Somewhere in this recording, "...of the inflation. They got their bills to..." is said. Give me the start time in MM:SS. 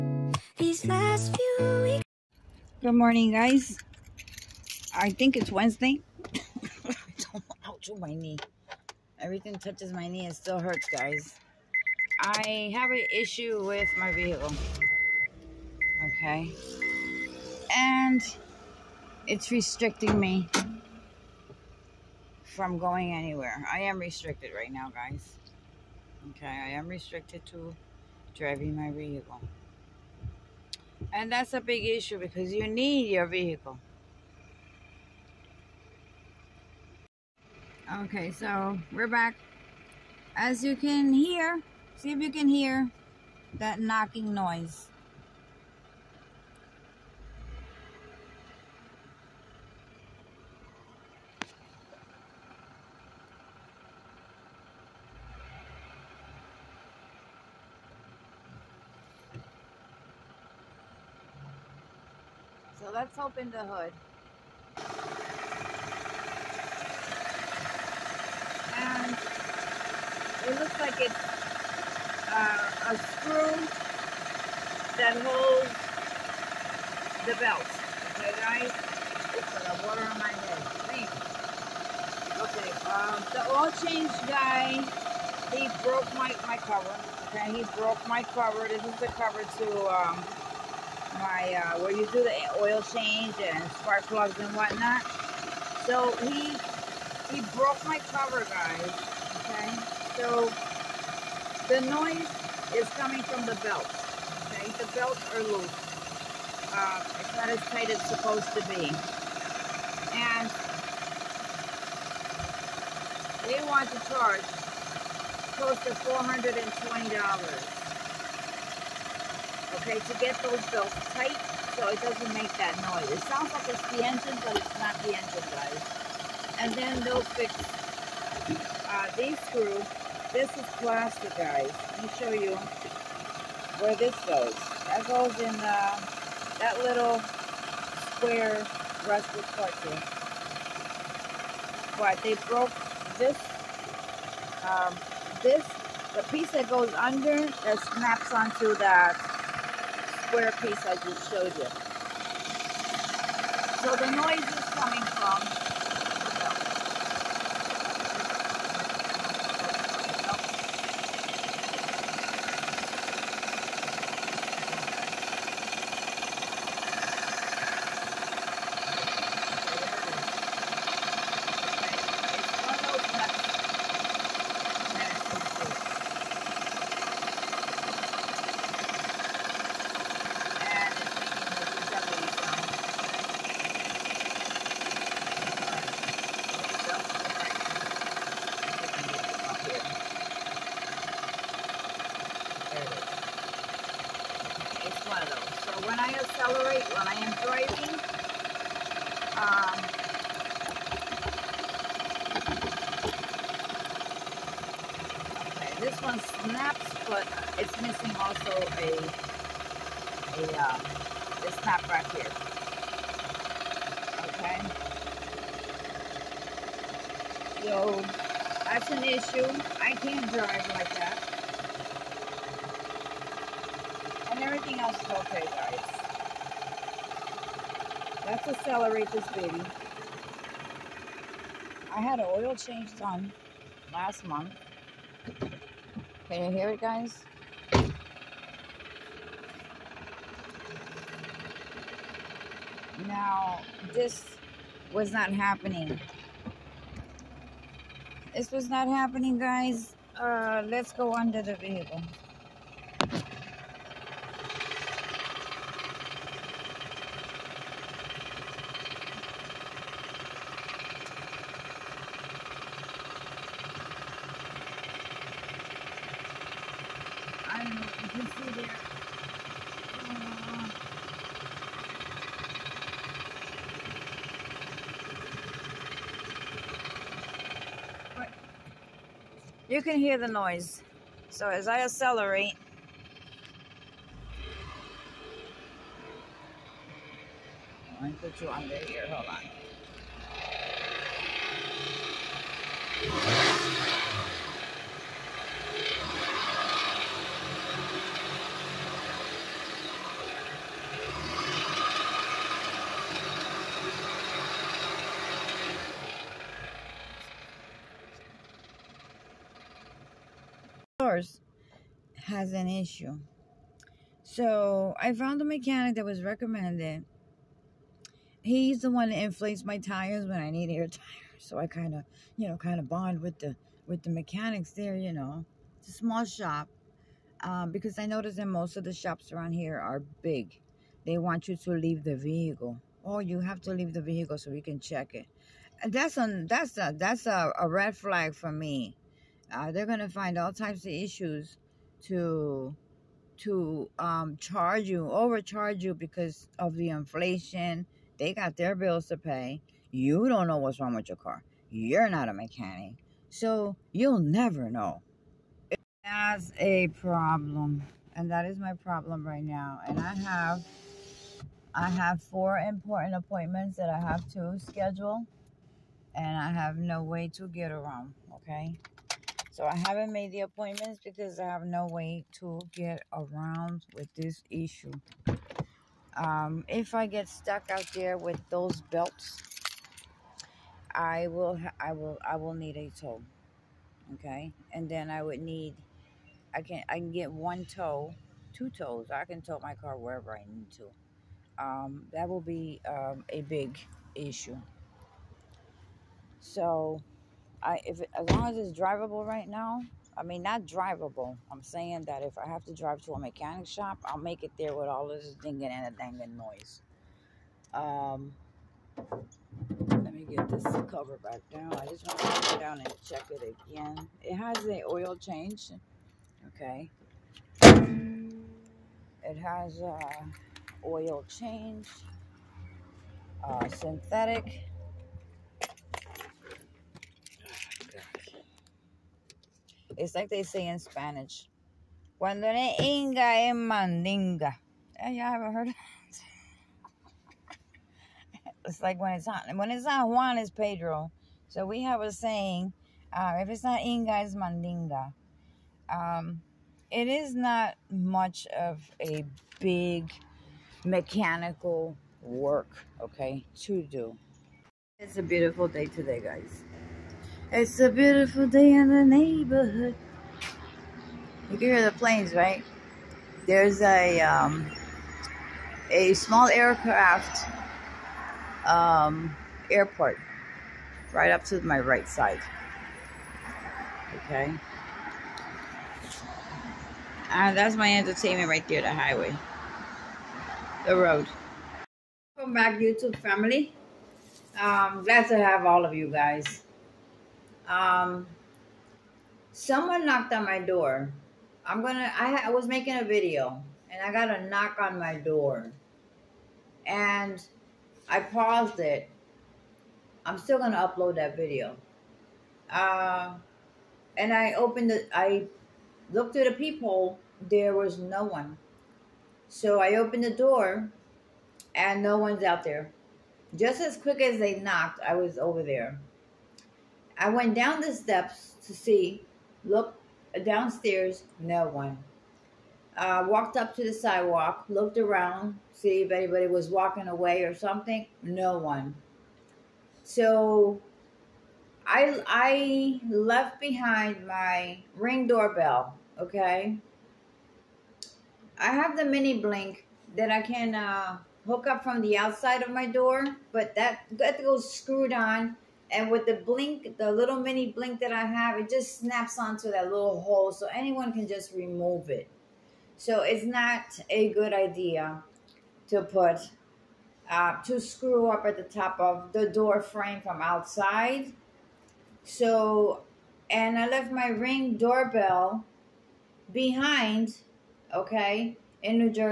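05:46.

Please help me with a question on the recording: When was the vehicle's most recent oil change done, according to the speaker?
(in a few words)
last month.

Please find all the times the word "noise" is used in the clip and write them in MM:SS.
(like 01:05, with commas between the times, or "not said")
00:44, 01:41, 02:02, 02:34, 04:40, 06:46.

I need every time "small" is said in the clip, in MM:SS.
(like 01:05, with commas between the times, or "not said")
05:25, 07:46.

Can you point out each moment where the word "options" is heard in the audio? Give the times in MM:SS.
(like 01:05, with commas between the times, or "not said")
not said.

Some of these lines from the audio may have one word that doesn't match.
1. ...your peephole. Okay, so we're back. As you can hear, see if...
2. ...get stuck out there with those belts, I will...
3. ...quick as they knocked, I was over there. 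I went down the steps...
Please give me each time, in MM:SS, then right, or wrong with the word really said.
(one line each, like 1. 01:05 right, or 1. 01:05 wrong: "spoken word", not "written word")
1. 00:33 wrong: "vehicle", not "peephole"
2. 06:17 right
3. 08:33 right.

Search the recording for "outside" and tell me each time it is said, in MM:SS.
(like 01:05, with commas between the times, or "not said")
09:02, 09:20.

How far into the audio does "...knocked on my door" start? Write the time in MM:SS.
08:10.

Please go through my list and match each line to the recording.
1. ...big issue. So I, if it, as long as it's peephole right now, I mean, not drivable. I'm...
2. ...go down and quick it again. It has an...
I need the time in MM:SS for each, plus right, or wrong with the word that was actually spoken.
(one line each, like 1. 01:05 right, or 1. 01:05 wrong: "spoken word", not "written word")
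1. 06:33 wrong: "drivable", not "peephole"
2. 06:52 wrong: "check", not "quick".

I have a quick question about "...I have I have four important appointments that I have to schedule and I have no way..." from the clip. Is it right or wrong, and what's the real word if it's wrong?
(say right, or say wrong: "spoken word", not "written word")
right.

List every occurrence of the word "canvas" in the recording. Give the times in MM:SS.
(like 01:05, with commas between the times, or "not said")
not said.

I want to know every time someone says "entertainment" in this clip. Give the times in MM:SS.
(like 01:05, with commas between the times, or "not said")
07:57.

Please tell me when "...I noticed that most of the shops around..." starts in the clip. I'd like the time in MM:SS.
05:27.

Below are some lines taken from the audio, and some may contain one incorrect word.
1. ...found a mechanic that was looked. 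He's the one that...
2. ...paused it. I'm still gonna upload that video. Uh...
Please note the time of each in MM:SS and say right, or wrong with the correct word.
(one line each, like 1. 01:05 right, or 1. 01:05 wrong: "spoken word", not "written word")
1. 05:15 wrong: "recommended", not "looked"
2. 08:18 right.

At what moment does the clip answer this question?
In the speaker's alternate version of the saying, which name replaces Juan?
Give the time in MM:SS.
07:20.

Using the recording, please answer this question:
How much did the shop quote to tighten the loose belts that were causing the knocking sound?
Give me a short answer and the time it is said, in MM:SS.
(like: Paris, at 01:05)
$420, at 01:56.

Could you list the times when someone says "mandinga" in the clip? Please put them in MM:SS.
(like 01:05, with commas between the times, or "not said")
07:13, 07:24.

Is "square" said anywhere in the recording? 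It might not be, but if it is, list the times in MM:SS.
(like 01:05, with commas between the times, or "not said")
02:18, 02:30.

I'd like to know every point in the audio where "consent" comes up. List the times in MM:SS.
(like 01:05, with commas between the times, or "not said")
not said.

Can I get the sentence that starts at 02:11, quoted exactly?
Let me show you where this goes.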